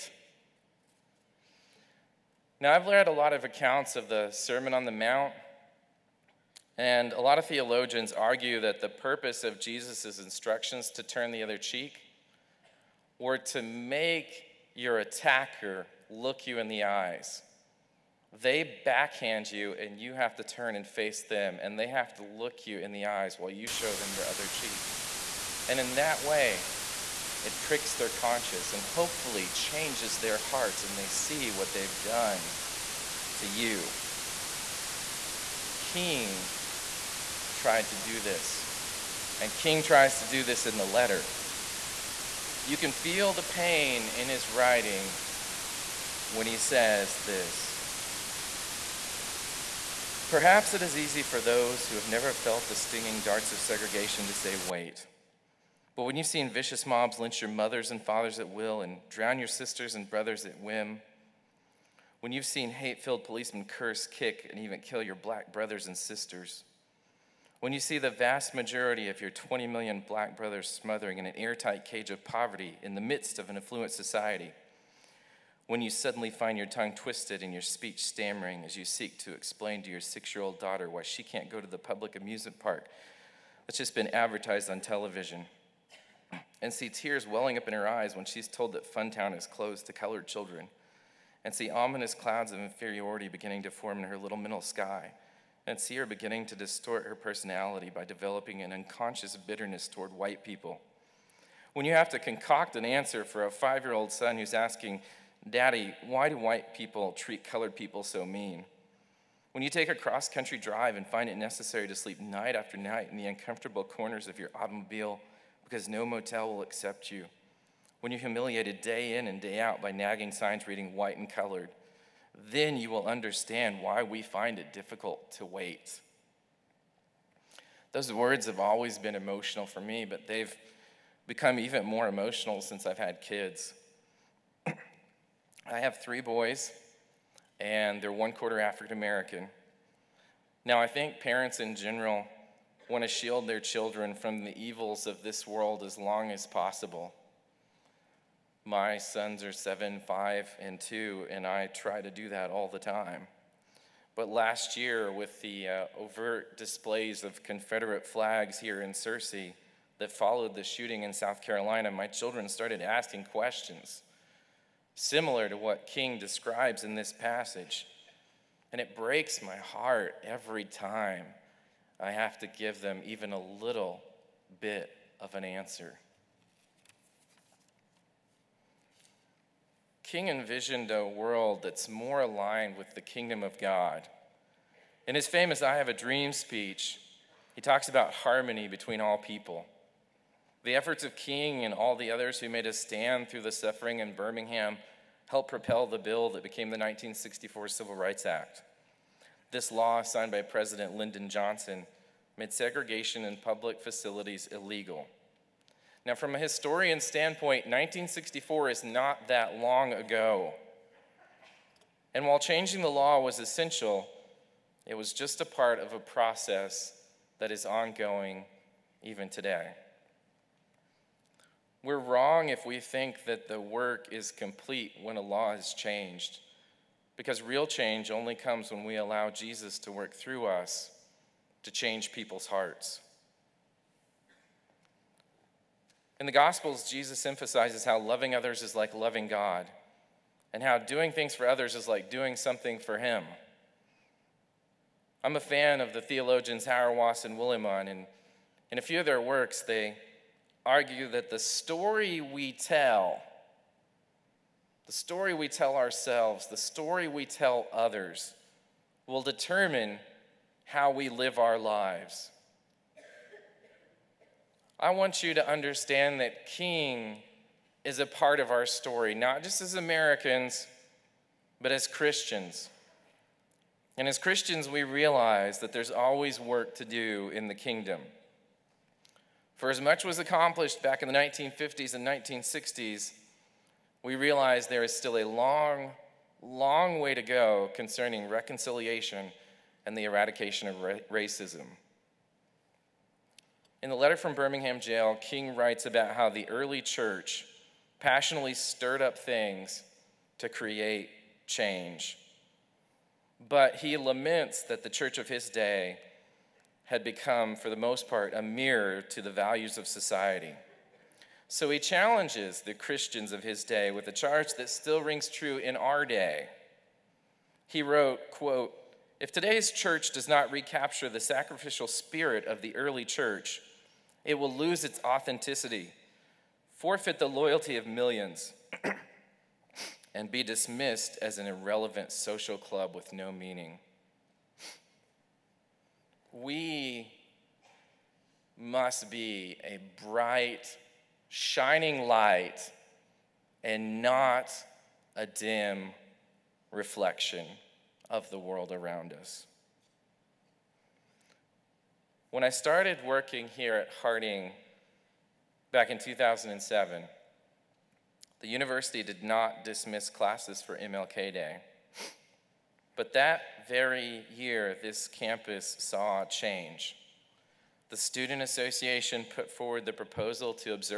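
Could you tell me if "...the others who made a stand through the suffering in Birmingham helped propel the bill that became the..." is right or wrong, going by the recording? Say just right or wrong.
right.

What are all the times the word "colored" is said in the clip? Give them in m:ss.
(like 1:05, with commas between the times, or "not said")
1:29, 1:47, 2:01.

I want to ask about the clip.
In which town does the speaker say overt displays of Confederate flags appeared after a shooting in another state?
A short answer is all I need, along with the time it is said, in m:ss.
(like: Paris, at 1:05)
Searcy, at 2:38.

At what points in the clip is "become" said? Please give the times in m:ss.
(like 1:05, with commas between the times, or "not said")
2:11, 5:07.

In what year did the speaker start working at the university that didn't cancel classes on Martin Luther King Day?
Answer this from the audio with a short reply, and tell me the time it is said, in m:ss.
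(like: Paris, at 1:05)
2007, at 5:55.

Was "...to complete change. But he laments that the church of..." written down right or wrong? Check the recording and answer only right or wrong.
wrong.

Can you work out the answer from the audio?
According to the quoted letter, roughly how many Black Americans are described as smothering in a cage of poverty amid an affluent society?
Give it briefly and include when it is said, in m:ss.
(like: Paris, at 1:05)
20 million, at 1:09.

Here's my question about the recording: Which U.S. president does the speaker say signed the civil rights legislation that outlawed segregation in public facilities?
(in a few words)
Lyndon Johnson.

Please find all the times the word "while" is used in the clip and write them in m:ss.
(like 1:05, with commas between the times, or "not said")
0:23, 3:32.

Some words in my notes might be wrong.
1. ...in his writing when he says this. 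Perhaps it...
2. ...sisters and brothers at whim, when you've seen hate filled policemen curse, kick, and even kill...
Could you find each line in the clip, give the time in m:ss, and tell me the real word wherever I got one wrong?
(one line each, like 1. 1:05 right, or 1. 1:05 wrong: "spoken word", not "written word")
1. 0:44 right
2. 0:59 right.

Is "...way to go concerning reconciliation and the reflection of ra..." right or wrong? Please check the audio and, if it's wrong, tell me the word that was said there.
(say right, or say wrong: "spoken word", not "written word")
wrong: "eradication", not "reflection".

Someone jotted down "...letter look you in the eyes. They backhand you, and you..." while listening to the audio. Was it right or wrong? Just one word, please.
wrong.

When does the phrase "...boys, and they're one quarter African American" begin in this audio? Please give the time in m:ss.
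2:16.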